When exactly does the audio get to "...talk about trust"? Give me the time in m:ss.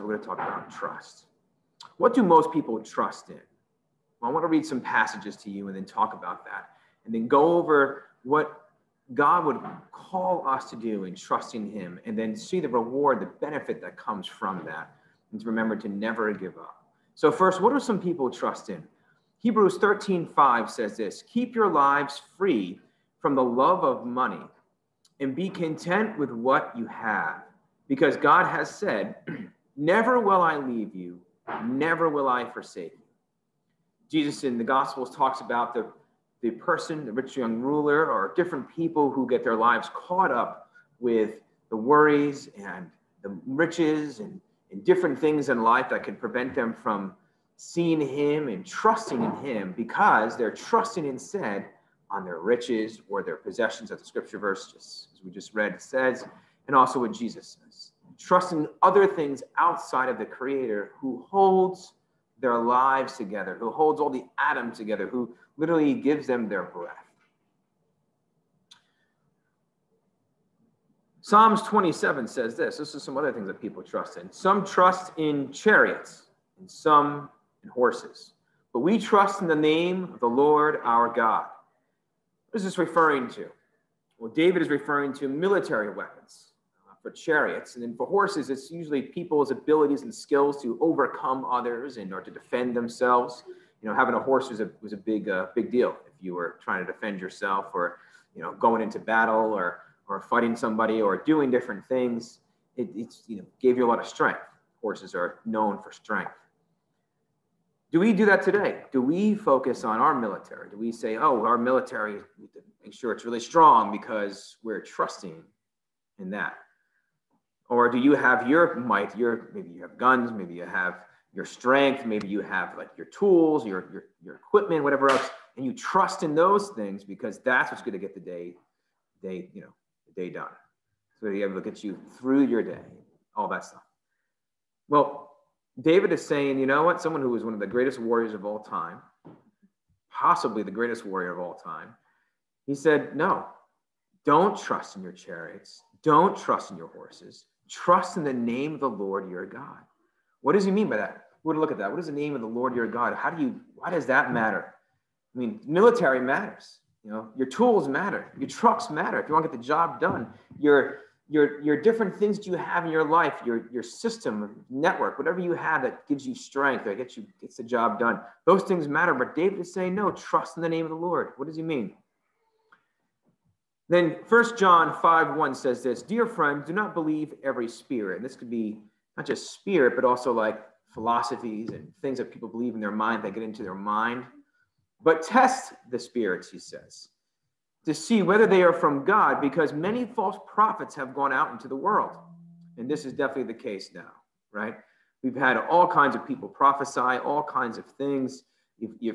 0:00.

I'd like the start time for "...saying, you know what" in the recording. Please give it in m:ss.
2:16.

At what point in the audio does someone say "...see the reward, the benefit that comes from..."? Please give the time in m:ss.
0:12.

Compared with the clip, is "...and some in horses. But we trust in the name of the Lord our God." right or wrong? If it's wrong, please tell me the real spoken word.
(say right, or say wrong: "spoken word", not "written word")
right.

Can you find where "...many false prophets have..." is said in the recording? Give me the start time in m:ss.
3:09.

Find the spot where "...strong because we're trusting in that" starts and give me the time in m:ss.
1:53.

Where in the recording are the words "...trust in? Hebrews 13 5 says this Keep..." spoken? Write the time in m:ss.
0:18.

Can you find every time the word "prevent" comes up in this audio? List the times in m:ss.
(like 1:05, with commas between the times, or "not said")
0:46.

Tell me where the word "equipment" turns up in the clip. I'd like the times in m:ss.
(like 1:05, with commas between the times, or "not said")
2:04.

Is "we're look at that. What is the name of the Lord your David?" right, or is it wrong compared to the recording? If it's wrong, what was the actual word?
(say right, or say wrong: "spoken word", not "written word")
wrong: "God", not "David".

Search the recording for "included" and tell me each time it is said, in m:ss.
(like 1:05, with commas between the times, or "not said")
not said.